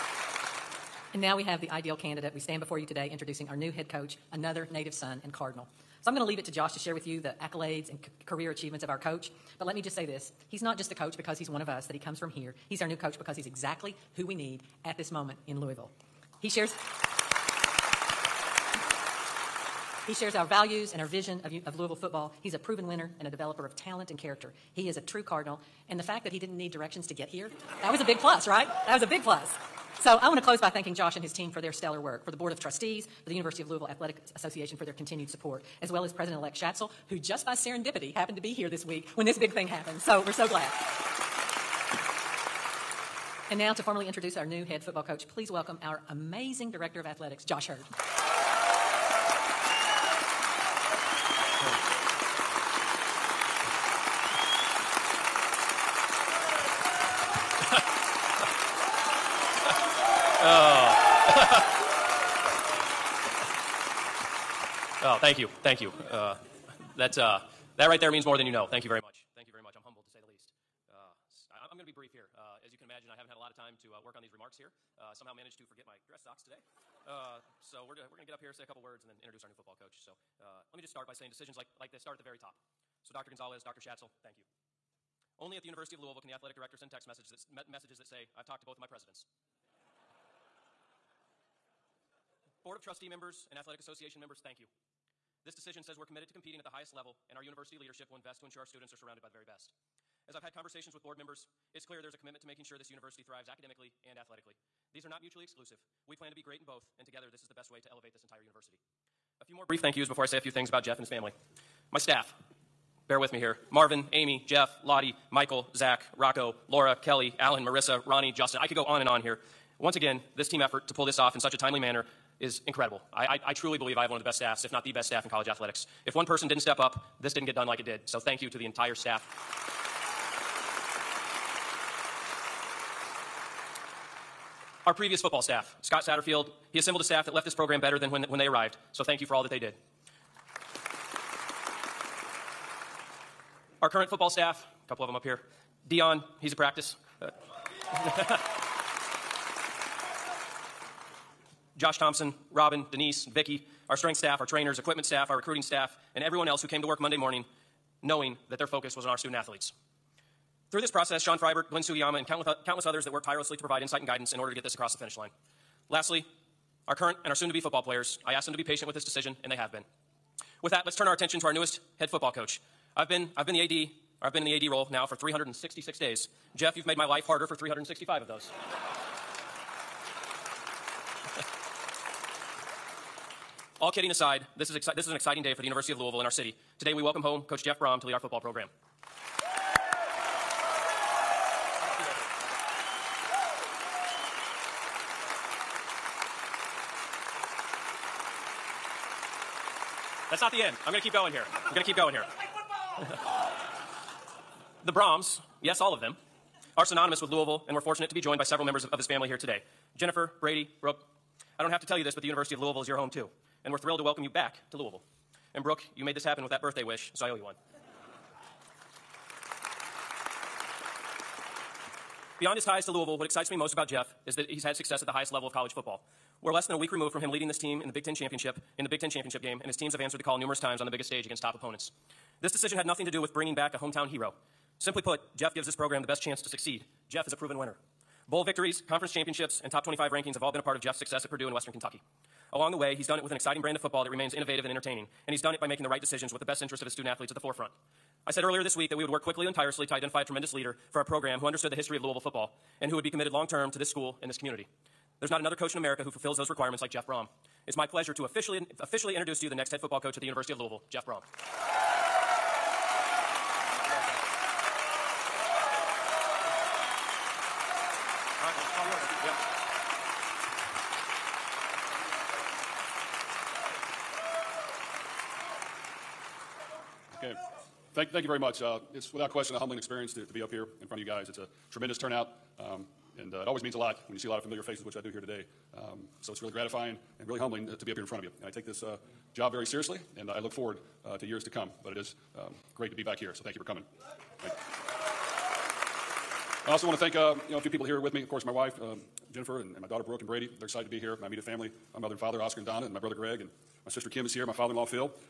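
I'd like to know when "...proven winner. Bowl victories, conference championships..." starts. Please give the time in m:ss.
3:57.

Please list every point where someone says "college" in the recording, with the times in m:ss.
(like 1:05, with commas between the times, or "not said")
2:05, 3:45.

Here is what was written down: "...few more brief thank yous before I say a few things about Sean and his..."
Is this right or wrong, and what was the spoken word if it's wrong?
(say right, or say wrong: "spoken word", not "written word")
wrong: "Jeff", not "Sean".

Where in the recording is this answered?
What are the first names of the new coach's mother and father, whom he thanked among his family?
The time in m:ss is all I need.
5:02.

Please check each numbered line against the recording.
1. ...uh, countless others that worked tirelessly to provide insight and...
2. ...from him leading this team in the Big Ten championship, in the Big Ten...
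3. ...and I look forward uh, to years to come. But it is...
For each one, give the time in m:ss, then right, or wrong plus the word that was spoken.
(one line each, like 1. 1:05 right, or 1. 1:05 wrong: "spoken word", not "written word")
1. 2:42 right
2. 3:47 right
3. 4:50 right.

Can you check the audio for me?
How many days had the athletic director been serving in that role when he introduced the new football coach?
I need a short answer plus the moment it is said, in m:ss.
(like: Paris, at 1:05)
366, at 2:55.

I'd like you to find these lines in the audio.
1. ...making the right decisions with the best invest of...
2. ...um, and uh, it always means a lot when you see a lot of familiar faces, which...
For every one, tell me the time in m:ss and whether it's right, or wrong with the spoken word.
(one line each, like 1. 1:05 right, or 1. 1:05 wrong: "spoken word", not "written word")
1. 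4:05 wrong: "interest", not "invest"
2. 4:42 right.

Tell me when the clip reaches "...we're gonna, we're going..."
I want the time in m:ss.
1:17.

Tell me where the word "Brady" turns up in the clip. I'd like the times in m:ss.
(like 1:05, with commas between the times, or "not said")
3:30, 5:00.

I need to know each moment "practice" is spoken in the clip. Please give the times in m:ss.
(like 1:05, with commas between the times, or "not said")
2:26.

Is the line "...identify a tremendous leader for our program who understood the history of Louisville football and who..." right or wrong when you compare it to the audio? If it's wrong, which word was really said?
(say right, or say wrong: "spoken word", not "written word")
right.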